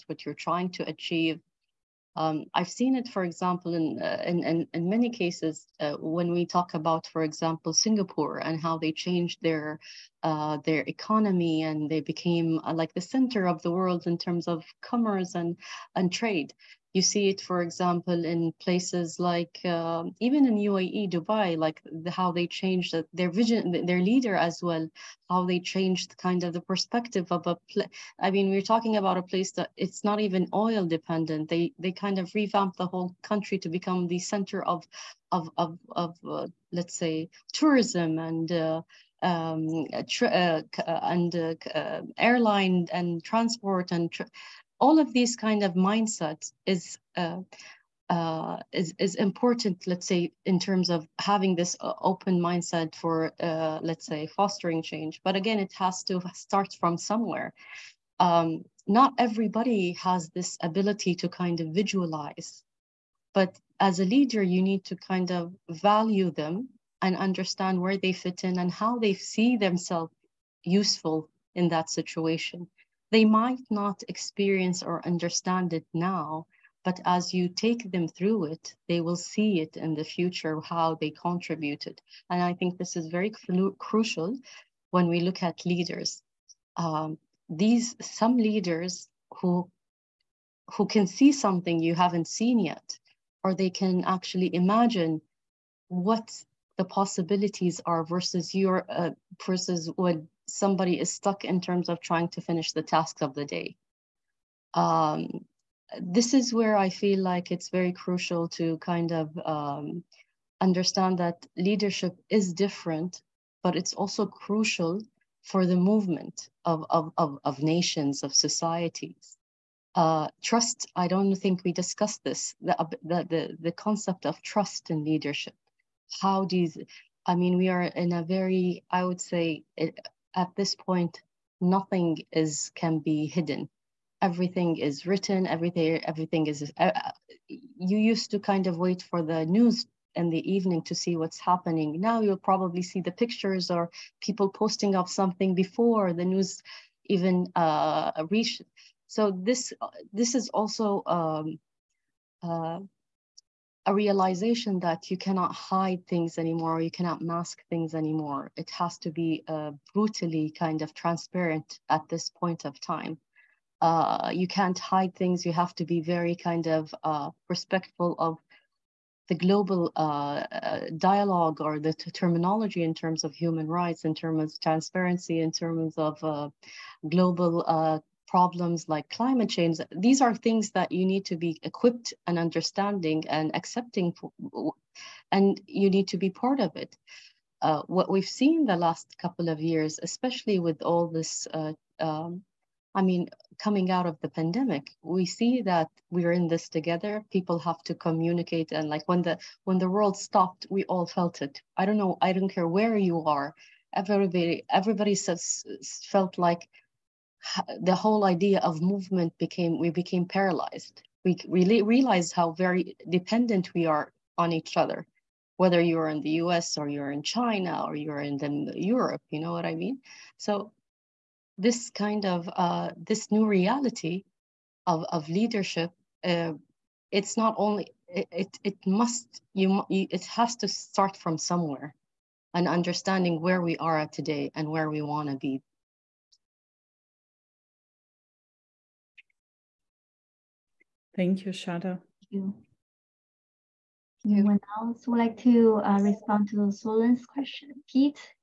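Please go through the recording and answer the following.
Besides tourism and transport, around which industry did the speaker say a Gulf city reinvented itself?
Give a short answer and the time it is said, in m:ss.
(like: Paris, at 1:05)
airline, at 0:42.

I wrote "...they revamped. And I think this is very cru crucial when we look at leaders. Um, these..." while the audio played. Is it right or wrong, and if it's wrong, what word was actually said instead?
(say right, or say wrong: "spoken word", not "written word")
wrong: "contributed", not "revamped".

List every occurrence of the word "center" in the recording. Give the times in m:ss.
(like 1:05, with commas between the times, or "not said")
0:13, 0:34.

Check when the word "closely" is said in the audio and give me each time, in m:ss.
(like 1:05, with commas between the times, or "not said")
not said.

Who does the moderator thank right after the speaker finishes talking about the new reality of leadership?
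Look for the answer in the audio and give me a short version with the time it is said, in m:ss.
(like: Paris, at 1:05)
Shada, at 4:01.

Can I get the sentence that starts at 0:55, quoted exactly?
But again, it has to start from somewhere.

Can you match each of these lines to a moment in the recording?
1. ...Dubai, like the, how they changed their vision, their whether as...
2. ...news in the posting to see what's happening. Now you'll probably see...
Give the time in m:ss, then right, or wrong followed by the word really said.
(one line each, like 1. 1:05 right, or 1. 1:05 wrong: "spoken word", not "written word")
1. 0:21 wrong: "leader", not "whether"
2. 2:19 wrong: "evening", not "posting".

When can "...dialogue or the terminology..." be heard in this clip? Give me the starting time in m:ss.
2:50.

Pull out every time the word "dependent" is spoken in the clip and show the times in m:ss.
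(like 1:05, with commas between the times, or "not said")
0:30, 3:33.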